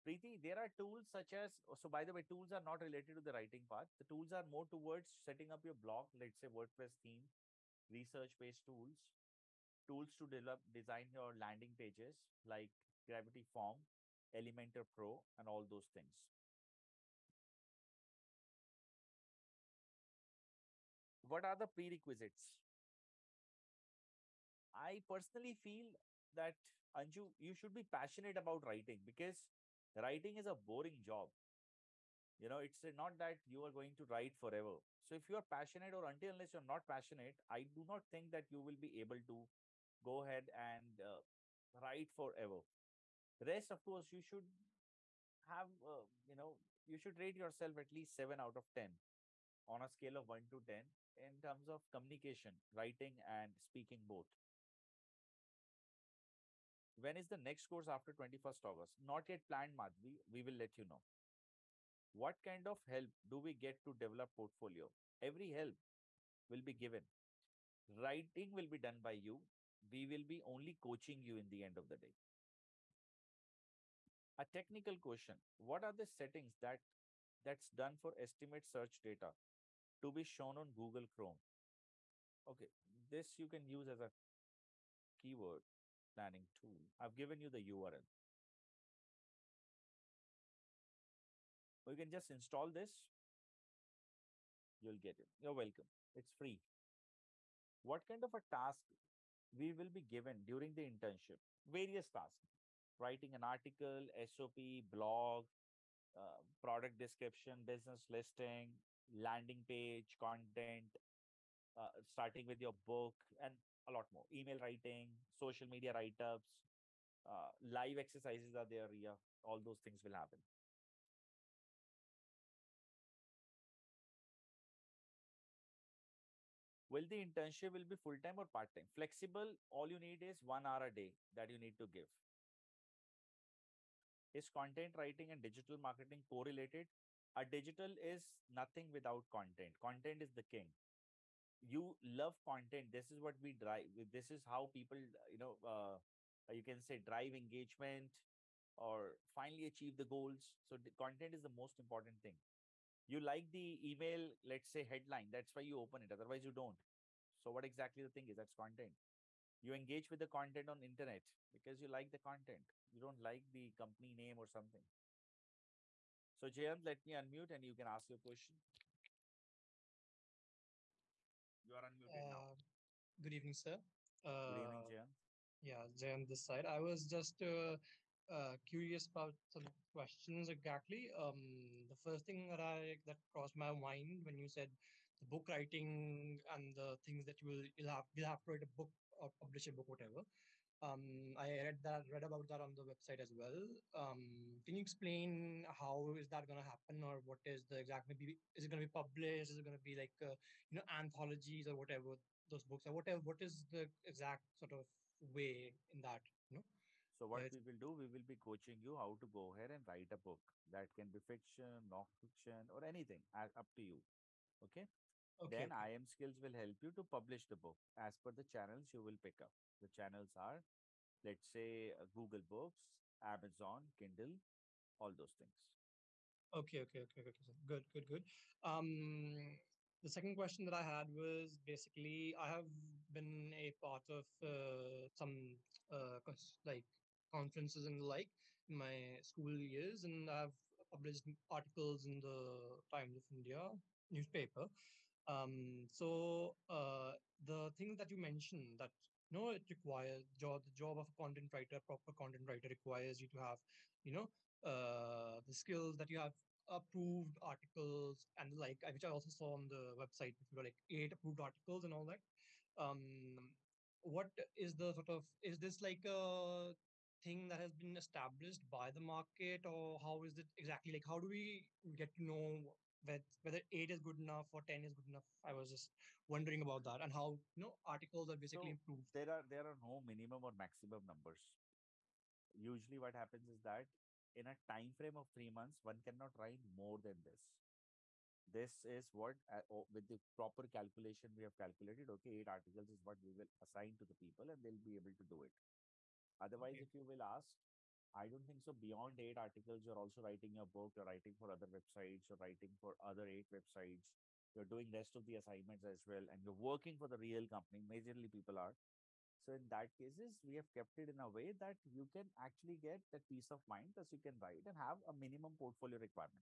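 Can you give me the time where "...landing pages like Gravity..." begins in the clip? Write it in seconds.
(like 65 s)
11 s.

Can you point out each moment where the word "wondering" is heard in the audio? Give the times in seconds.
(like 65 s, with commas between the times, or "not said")
276 s.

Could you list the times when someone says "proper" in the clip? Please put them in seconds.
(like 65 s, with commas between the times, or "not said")
251 s, 290 s.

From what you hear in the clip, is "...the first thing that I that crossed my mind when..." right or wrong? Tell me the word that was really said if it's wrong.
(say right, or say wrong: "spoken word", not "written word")
right.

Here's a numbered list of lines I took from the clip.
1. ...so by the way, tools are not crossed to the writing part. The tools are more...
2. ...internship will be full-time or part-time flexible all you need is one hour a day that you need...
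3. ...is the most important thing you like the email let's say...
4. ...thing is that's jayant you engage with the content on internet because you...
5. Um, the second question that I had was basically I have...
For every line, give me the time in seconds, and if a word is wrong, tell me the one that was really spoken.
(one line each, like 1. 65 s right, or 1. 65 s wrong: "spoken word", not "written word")
1. 1 s wrong: "related", not "crossed"
2. 127 s right
3. 151 s right
4. 158 s wrong: "content", not "jayant"
5. 228 s right.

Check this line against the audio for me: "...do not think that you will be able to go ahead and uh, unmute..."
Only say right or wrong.
wrong.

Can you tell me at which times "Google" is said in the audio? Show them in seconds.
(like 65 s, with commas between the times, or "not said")
80 s, 222 s.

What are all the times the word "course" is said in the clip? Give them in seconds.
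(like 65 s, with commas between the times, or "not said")
43 s, 57 s.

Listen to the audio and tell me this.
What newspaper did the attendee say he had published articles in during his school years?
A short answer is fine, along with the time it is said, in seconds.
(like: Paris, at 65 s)
Times of India, at 242 s.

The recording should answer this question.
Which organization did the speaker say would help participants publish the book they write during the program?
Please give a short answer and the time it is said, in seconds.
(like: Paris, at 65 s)
IIM Skills, at 215 s.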